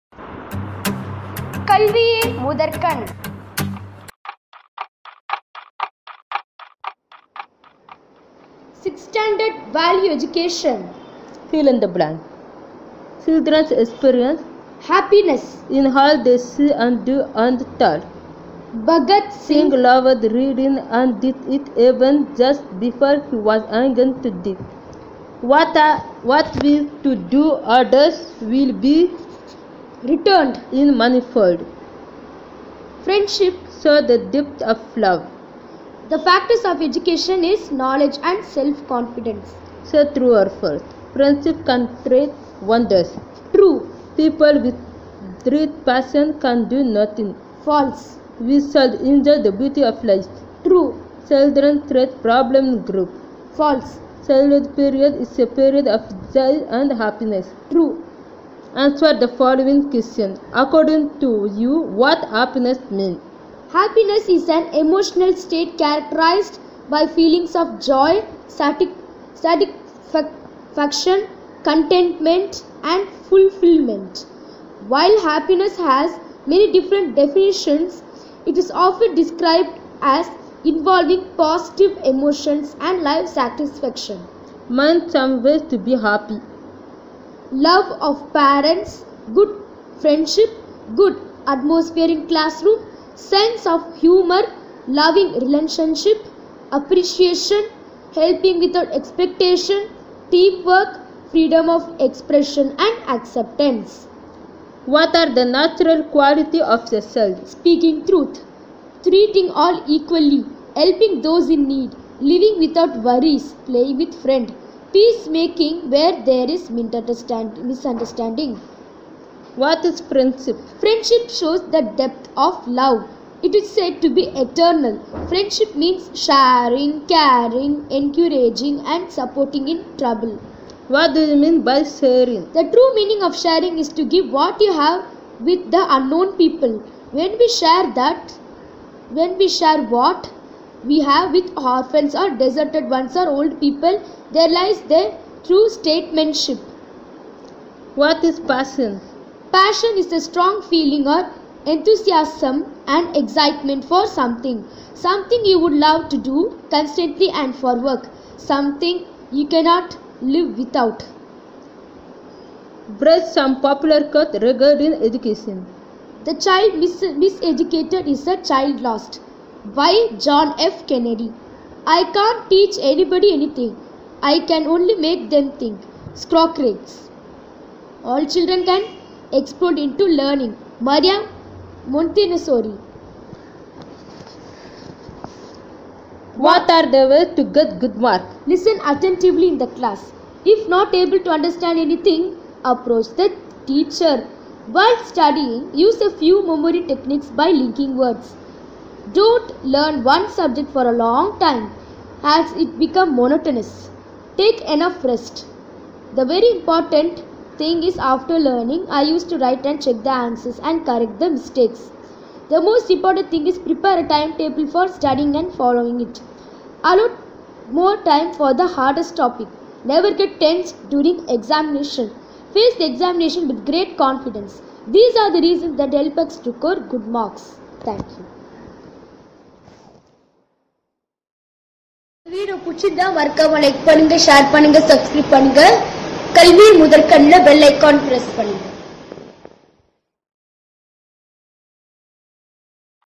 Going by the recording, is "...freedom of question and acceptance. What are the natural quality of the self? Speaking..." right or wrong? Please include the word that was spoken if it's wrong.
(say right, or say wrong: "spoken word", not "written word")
wrong: "expression", not "question".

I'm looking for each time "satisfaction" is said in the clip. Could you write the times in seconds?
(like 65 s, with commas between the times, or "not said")
68 s, 83 s.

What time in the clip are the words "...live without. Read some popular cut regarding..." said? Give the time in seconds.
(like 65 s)
160 s.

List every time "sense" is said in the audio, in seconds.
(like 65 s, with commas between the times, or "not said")
93 s.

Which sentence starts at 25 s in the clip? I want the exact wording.
what will to do others will be returned in manifold.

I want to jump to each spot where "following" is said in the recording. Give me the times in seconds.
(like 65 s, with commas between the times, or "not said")
59 s, 215 s.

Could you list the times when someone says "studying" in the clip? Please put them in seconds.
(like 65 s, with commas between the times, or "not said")
195 s, 214 s.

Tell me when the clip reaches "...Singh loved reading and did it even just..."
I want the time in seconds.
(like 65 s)
19 s.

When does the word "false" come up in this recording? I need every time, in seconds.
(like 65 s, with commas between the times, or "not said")
40 s, 47 s, 53 s.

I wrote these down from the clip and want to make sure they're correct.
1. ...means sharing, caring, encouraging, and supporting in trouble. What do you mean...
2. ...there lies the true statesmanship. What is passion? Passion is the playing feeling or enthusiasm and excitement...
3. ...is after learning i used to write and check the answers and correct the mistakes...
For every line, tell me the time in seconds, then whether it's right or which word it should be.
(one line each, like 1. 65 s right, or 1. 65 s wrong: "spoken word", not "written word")
1. 125 s right
2. 144 s wrong: "strong", not "playing"
3. 207 s right.